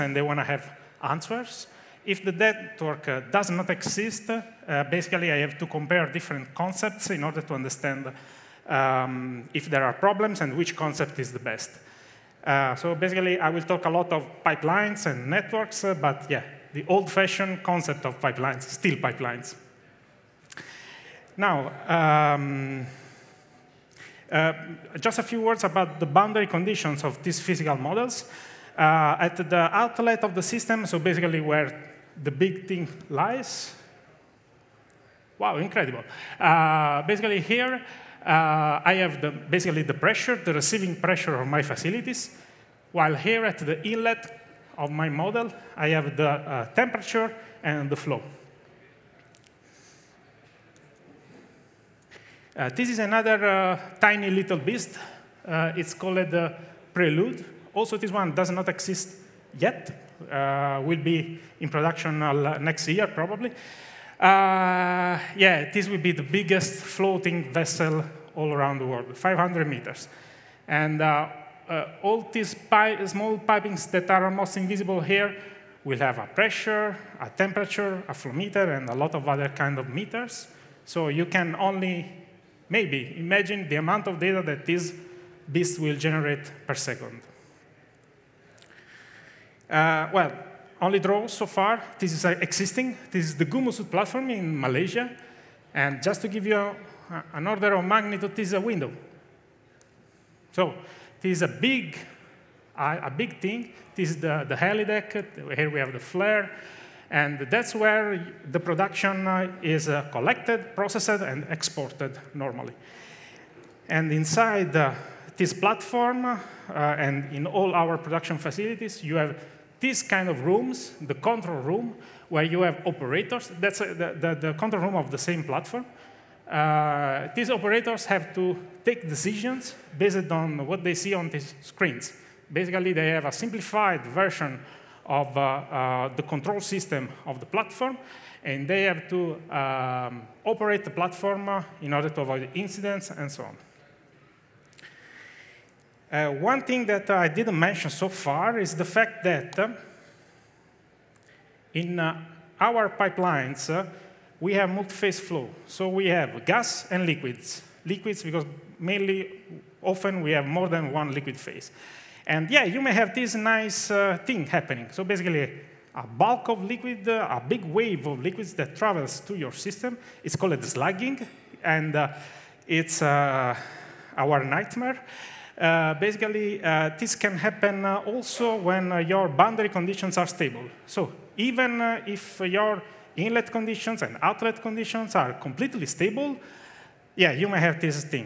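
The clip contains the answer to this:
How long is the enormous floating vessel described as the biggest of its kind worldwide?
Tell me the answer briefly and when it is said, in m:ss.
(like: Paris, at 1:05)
500 meters, at 1:09.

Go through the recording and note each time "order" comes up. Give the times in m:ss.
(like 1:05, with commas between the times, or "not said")
0:07, 1:37, 2:21.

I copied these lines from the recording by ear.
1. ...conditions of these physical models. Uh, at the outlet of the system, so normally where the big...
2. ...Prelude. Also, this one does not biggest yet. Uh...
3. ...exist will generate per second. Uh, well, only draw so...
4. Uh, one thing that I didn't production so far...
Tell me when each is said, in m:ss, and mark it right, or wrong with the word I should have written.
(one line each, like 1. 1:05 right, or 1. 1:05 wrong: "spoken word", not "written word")
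1. 0:26 wrong: "basically", not "normally"
2. 0:56 wrong: "exist", not "biggest"
3. 1:25 wrong: "beast", not "exist"
4. 2:26 wrong: "mention", not "production".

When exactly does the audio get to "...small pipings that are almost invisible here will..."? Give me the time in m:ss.
1:13.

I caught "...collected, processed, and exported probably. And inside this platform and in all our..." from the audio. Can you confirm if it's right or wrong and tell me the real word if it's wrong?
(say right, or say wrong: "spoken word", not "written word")
wrong: "normally", not "probably".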